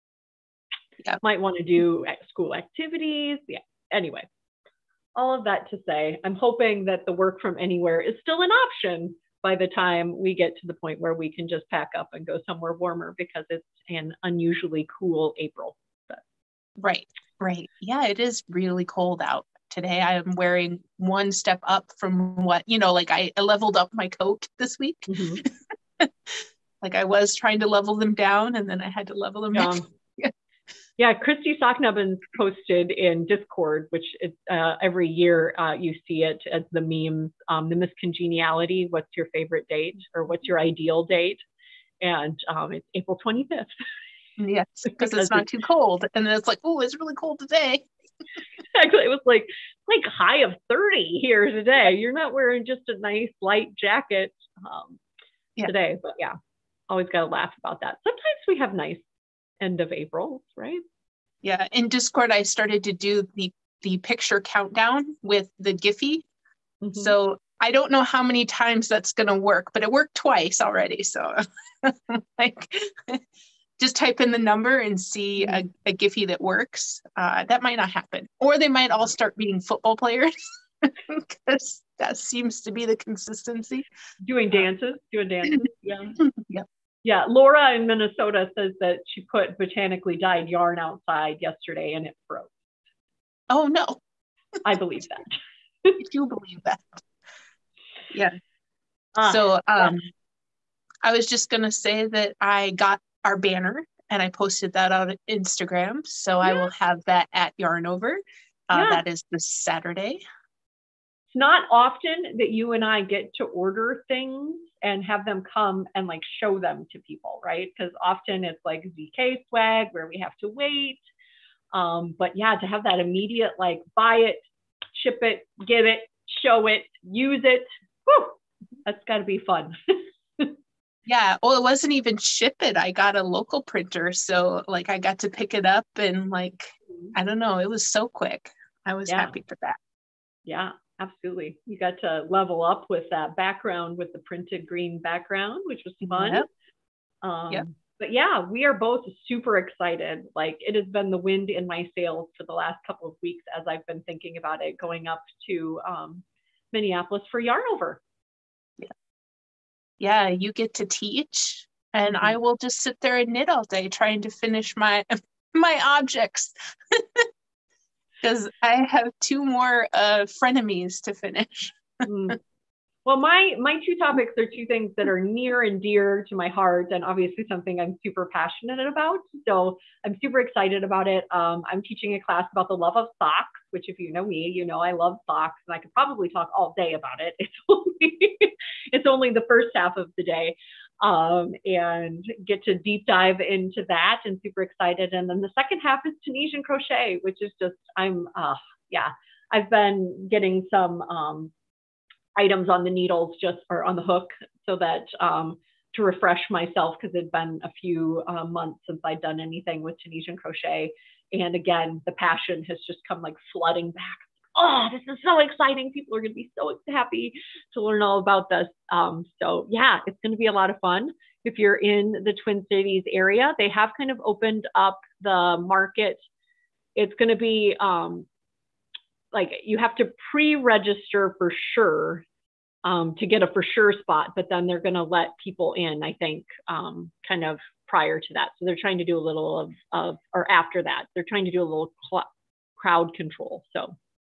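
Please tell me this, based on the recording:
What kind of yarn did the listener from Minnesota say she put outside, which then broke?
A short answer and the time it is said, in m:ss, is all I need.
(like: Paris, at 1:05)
Botanically dyed yarn, at 1:29.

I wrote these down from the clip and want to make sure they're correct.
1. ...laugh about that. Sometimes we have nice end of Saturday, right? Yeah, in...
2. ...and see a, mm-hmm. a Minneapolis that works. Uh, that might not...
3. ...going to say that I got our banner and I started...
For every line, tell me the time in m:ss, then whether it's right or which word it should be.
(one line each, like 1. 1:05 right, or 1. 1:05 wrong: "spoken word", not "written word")
1. 0:57 wrong: "April", not "Saturday"
2. 1:14 wrong: "Giphy", not "Minneapolis"
3. 1:41 wrong: "posted", not "started".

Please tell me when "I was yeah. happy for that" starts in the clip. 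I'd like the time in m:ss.
2:18.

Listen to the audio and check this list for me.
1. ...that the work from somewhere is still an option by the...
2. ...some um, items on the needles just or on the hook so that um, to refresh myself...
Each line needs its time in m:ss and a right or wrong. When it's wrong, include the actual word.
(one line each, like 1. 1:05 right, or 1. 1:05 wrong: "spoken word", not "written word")
1. 0:06 wrong: "anywhere", not "somewhere"
2. 3:20 right.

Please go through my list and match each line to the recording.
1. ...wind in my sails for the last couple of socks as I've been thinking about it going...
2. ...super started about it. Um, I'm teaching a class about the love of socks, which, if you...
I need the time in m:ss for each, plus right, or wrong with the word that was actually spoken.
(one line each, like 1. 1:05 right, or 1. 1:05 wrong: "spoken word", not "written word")
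1. 2:31 wrong: "weeks", not "socks"
2. 3:00 wrong: "excited", not "started".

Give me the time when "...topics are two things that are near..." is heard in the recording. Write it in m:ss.
2:53.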